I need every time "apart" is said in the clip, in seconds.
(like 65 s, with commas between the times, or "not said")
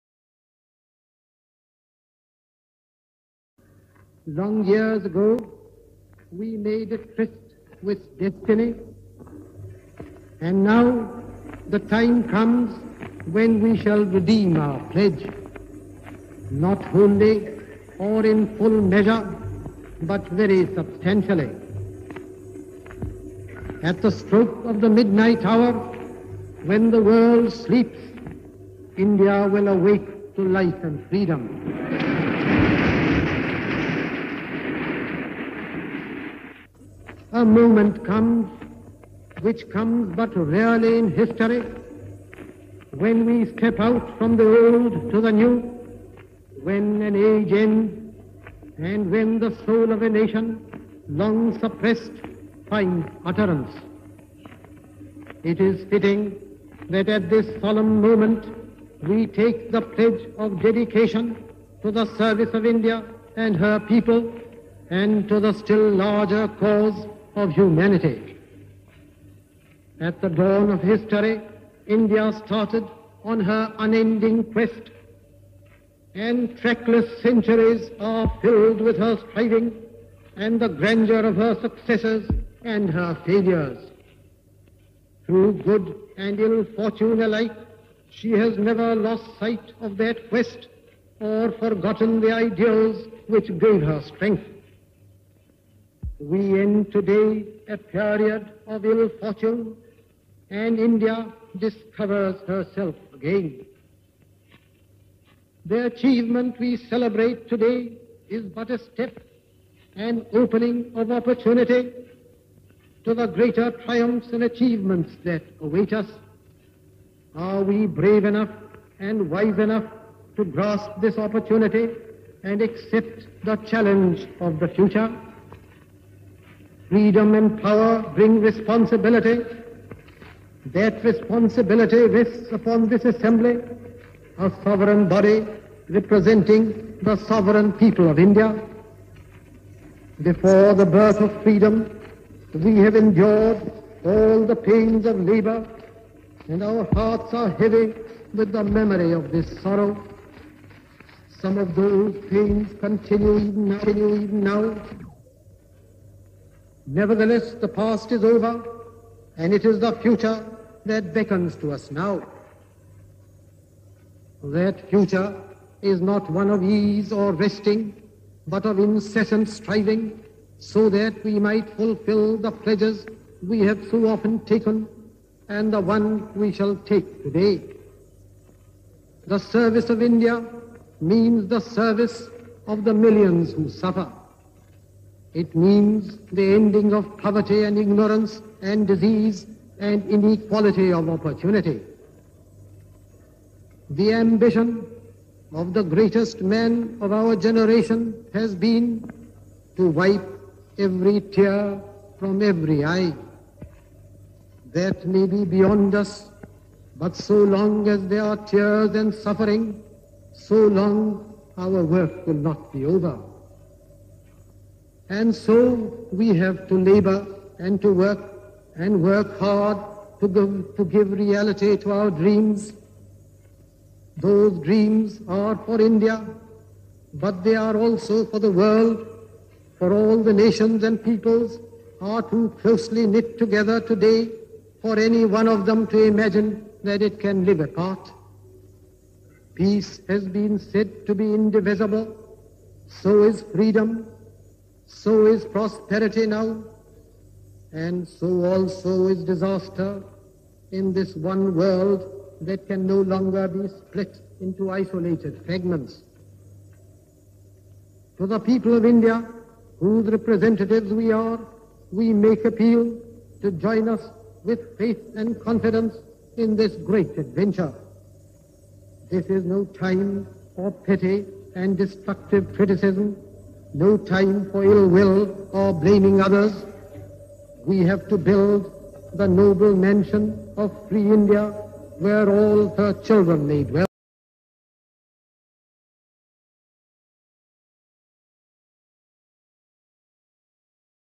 237 s.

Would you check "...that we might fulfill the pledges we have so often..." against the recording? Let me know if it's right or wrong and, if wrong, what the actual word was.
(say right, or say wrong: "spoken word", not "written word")
right.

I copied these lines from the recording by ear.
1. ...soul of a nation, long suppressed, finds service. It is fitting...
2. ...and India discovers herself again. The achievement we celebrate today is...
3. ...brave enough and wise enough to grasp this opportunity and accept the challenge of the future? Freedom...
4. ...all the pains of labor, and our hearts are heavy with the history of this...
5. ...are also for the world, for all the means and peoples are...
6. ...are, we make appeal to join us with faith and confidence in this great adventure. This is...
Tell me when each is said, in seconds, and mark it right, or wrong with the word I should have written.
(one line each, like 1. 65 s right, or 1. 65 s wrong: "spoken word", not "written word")
1. 49 s wrong: "utterance", not "service"
2. 100 s right
3. 117 s right
4. 144 s wrong: "memory", not "history"
5. 227 s wrong: "nations", not "means"
6. 261 s right.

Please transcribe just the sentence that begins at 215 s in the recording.
And so we have to labor and to work and work hard to give, to give reality to our dreams.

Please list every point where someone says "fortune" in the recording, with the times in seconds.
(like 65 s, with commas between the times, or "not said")
86 s, 99 s.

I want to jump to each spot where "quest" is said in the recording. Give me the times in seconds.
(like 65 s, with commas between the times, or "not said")
74 s, 90 s.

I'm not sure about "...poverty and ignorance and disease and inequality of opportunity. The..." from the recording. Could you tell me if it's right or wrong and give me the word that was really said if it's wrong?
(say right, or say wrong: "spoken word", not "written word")
right.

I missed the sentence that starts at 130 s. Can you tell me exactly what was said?
That responsibility rests upon this assembly, a sovereign body representing the sovereign people of India.